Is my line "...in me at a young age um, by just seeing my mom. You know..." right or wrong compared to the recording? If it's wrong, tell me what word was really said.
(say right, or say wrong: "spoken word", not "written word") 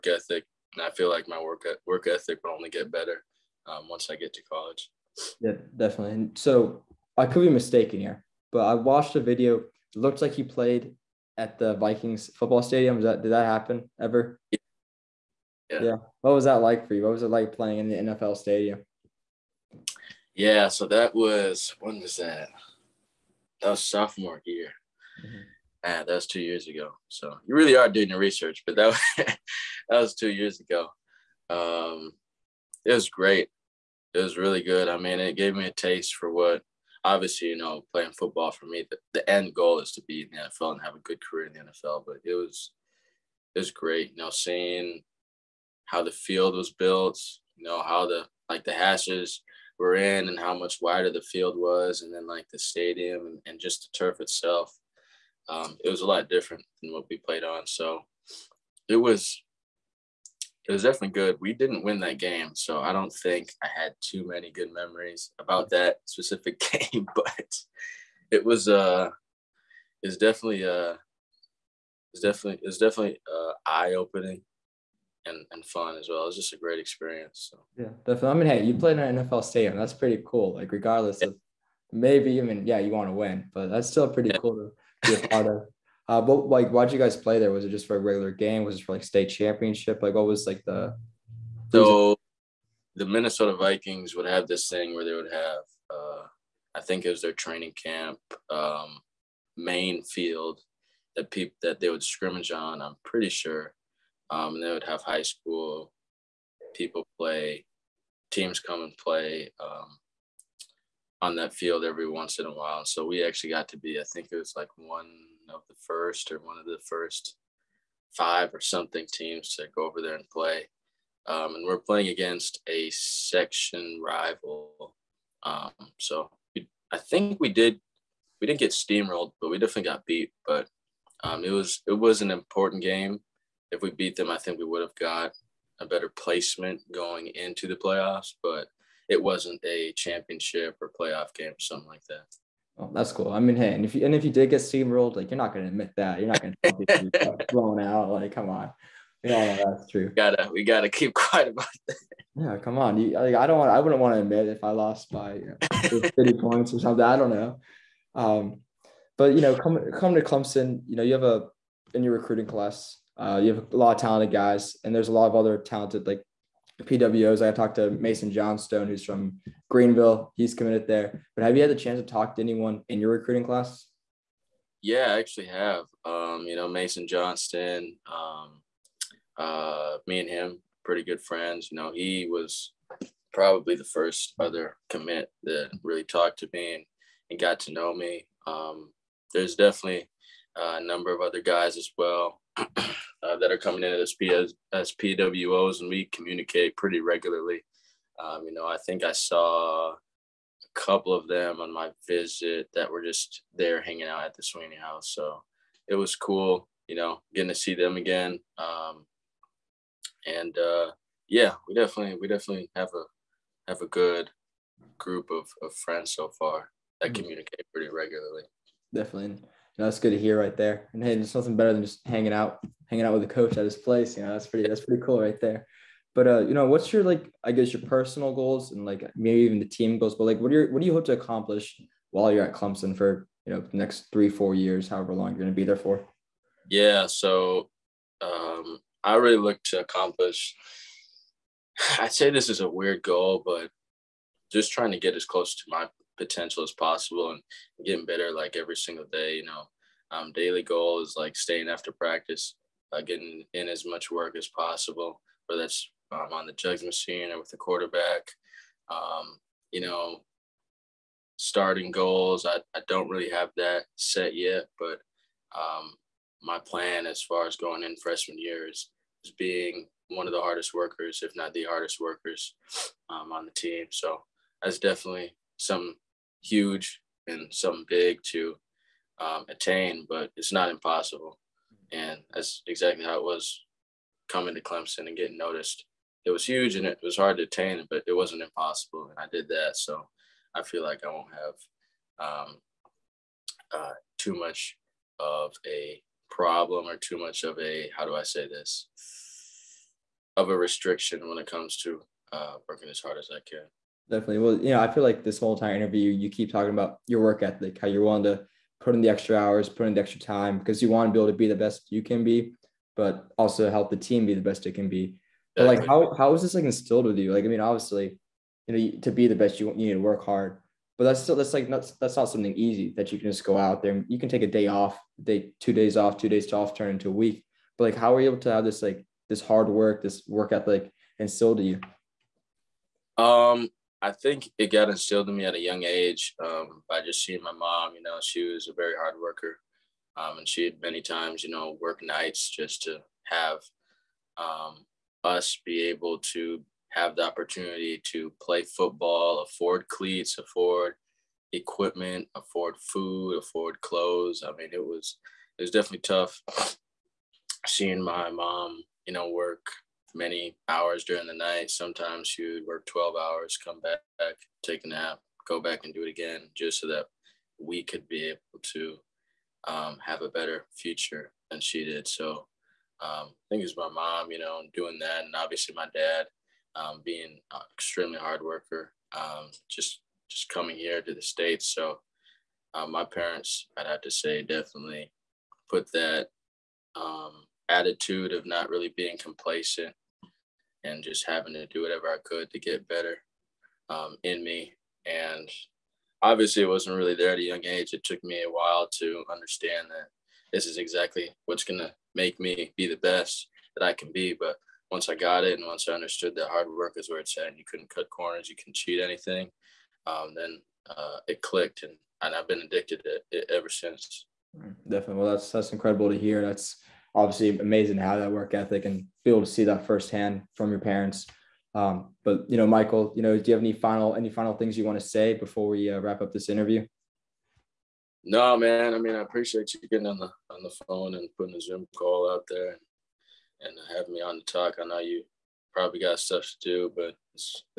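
right.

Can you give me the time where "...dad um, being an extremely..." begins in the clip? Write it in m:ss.
6:15.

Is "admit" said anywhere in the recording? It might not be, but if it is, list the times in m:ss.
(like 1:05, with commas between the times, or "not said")
2:25, 2:34.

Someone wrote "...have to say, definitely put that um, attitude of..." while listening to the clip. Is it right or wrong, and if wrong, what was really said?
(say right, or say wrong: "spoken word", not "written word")
right.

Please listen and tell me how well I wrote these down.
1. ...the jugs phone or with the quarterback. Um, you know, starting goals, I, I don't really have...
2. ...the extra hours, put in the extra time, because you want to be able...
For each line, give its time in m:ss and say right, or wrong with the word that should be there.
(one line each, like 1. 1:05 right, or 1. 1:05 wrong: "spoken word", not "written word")
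1. 4:16 wrong: "machine", not "phone"
2. 5:09 right.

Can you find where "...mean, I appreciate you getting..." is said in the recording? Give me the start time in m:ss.
7:08.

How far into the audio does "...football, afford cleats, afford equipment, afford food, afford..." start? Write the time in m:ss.
5:48.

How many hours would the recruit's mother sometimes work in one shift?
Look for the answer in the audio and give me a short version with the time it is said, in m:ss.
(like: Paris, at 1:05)
12, at 6:02.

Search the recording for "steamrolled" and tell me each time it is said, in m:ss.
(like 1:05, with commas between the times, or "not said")
2:08, 2:24.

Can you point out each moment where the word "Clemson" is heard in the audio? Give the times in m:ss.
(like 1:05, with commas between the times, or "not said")
2:40, 3:52, 4:44.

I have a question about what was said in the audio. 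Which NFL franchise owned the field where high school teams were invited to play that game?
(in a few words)
Minnesota Vikings.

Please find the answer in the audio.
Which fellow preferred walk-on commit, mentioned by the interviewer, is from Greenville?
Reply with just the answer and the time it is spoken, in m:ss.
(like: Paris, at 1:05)
Mason Johnstone, at 2:47.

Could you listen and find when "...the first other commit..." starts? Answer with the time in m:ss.
3:03.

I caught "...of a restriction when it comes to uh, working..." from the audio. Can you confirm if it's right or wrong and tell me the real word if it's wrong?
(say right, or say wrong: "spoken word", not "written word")
right.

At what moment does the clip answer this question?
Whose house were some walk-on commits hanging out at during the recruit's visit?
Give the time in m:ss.
3:24.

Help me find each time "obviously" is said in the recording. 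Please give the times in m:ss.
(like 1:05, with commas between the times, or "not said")
0:37, 5:17, 6:15, 6:36, 6:57.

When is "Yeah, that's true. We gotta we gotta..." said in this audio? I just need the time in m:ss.
2:29.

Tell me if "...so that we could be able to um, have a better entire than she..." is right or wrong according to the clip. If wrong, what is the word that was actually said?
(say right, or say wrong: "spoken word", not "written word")
wrong: "future", not "entire".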